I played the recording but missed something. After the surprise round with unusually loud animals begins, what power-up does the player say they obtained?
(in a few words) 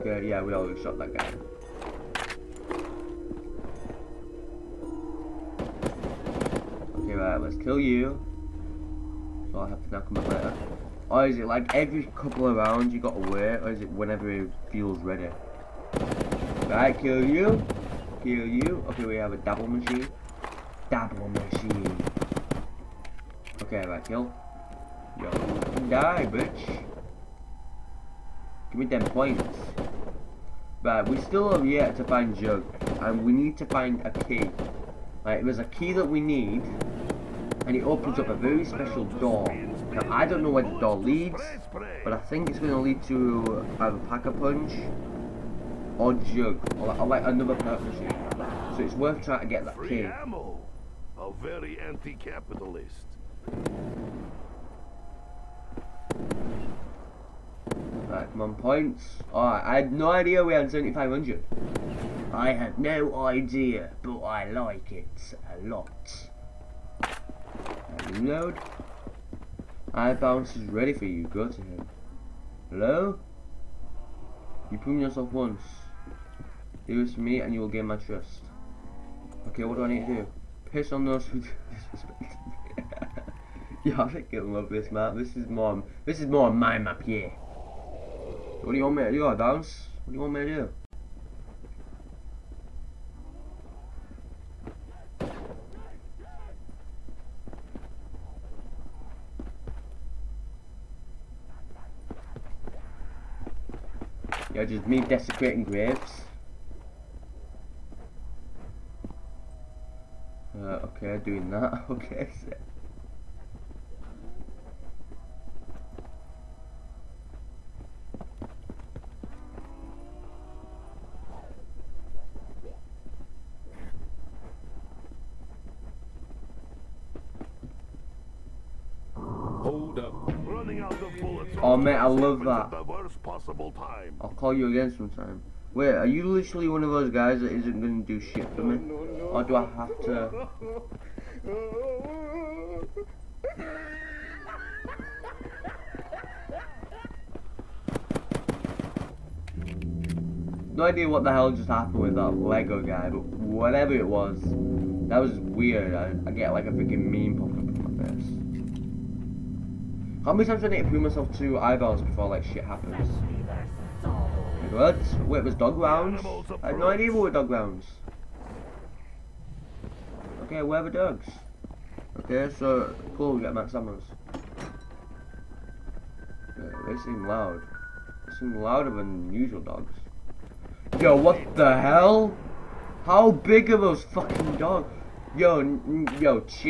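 Max Summers.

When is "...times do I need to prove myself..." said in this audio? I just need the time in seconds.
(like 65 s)
160 s.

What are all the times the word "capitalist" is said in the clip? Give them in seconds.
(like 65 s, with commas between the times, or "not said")
51 s.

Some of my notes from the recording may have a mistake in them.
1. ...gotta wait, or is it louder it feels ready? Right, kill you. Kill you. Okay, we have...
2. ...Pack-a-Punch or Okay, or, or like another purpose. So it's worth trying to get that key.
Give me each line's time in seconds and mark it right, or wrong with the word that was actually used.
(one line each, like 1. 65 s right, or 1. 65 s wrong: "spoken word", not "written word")
1. 12 s wrong: "whenever", not "louder"
2. 44 s wrong: "Jug", not "Okay".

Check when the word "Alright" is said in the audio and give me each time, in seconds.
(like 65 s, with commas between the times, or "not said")
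7 s, 59 s.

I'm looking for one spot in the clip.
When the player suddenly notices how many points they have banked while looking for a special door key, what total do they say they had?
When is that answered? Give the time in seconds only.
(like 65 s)
60 s.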